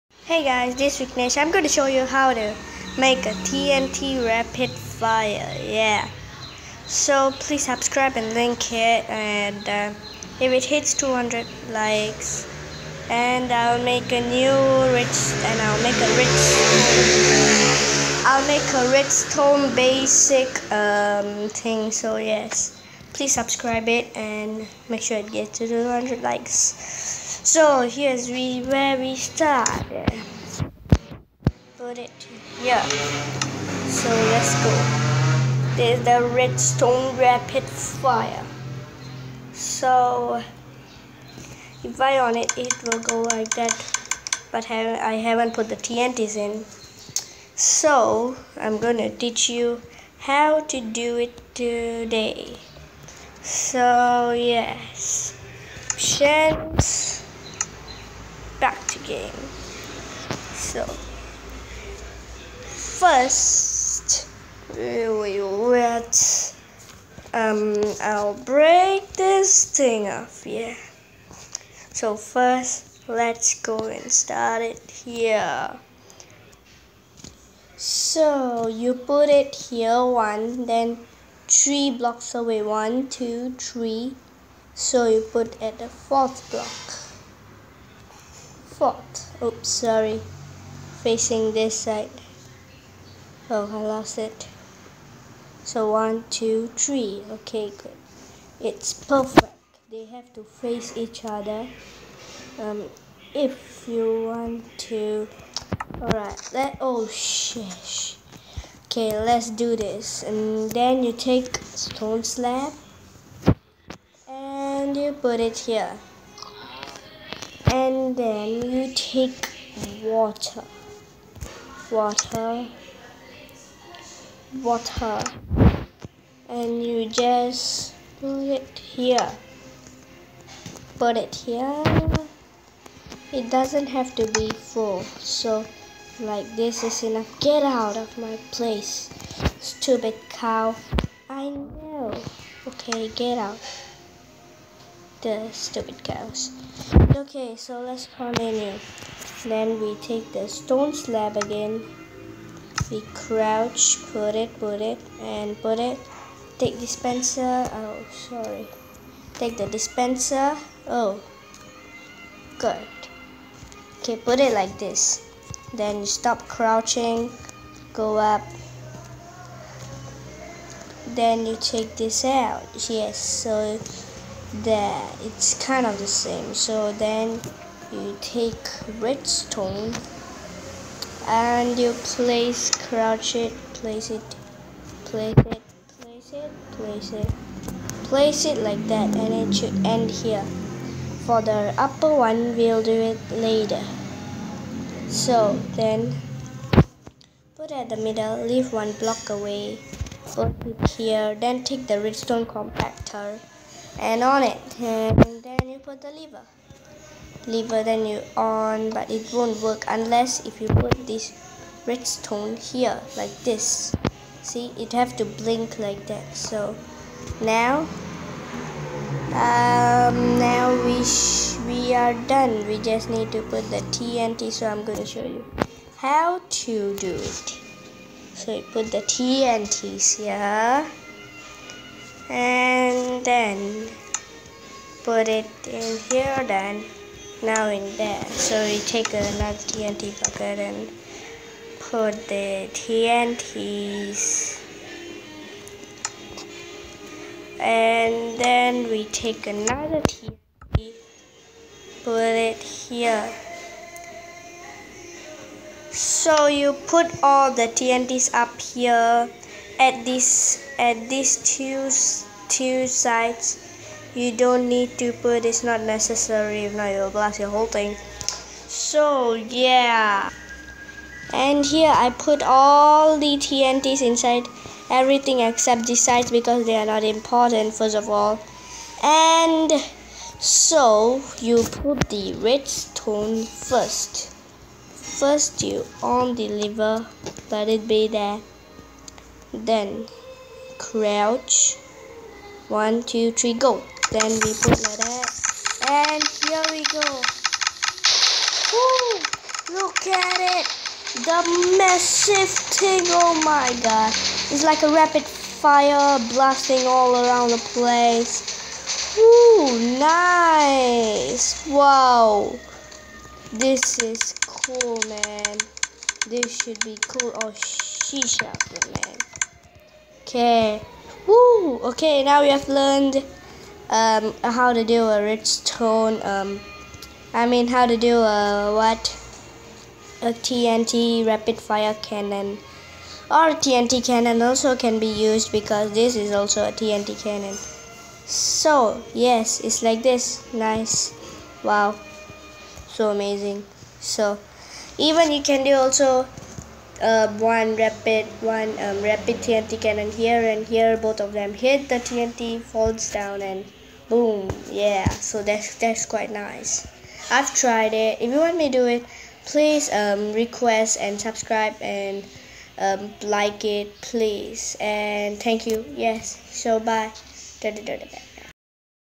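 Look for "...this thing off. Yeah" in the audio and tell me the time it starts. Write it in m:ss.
1:09.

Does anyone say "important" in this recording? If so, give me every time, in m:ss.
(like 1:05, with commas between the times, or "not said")
4:37.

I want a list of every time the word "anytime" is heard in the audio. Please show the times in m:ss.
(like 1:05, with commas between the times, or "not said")
not said.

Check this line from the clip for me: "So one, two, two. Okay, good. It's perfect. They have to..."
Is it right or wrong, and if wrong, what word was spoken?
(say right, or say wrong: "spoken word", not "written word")
wrong: "three", not "two".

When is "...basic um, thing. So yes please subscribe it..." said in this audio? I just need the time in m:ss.
0:19.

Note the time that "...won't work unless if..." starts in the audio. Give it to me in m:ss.
3:29.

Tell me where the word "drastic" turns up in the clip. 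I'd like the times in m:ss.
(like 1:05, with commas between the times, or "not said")
not said.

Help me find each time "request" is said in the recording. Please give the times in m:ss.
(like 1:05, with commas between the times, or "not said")
6:00.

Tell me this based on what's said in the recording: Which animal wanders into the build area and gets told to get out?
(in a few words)
cow.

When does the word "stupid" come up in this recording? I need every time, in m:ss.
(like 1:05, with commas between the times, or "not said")
2:19, 2:25.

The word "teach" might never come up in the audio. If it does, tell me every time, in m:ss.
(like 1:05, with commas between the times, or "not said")
0:49.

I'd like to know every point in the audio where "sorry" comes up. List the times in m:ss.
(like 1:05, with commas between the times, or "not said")
1:29, 2:38.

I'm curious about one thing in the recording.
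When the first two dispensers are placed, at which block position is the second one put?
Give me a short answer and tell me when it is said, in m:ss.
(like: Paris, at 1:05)
fourth block, at 1:25.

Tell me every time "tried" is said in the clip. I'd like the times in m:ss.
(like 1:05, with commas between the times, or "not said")
5:57.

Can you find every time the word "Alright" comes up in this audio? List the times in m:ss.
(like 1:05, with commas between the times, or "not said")
1:46.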